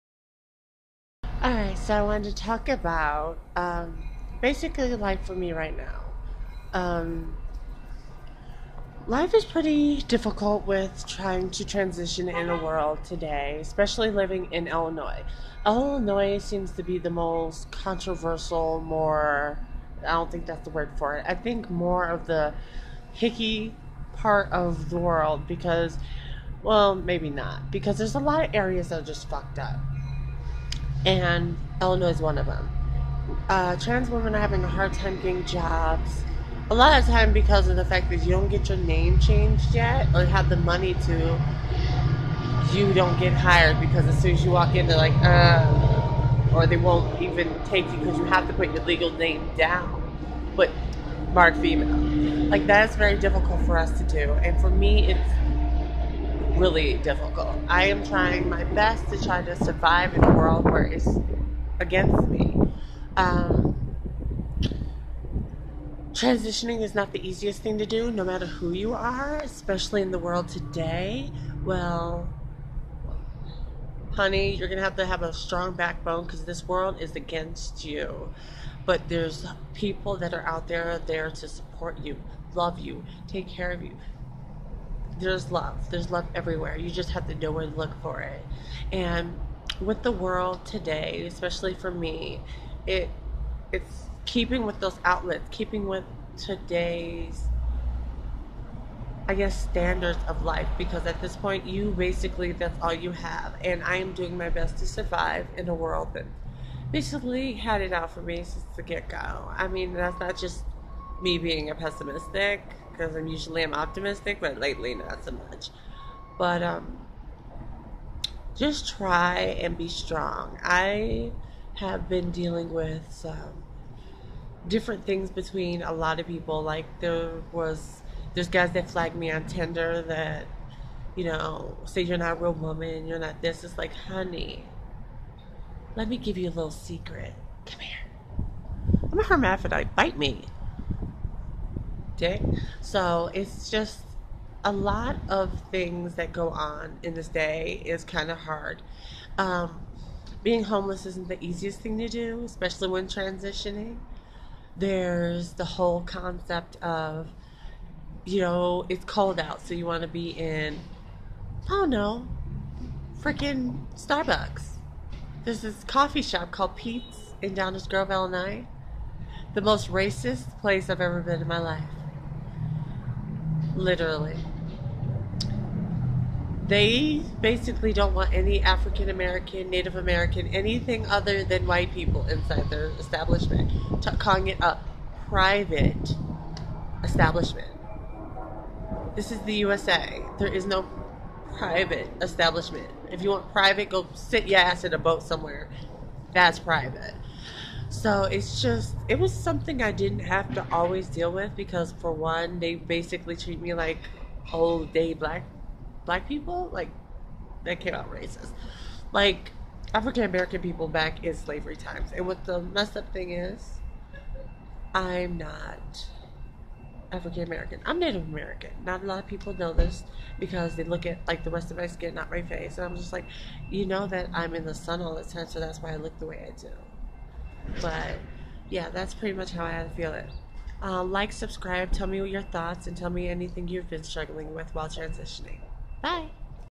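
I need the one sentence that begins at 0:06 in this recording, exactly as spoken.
Um, life is pretty difficult with trying to transition in a world today, especially living in Illinois.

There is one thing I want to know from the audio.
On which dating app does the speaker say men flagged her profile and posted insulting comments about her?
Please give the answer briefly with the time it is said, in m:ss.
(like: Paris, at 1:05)
Tinder, at 2:09.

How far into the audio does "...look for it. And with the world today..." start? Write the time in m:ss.
1:27.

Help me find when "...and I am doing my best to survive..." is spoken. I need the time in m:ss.
1:43.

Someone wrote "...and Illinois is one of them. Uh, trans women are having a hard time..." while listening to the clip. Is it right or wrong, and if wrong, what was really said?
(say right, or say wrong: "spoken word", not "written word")
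right.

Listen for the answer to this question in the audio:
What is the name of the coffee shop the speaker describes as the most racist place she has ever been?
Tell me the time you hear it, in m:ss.
2:46.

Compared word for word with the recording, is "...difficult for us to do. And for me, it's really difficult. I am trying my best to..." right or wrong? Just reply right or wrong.
right.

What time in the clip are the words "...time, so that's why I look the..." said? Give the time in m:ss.
3:45.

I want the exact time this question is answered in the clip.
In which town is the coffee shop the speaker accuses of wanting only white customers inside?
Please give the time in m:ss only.
2:47.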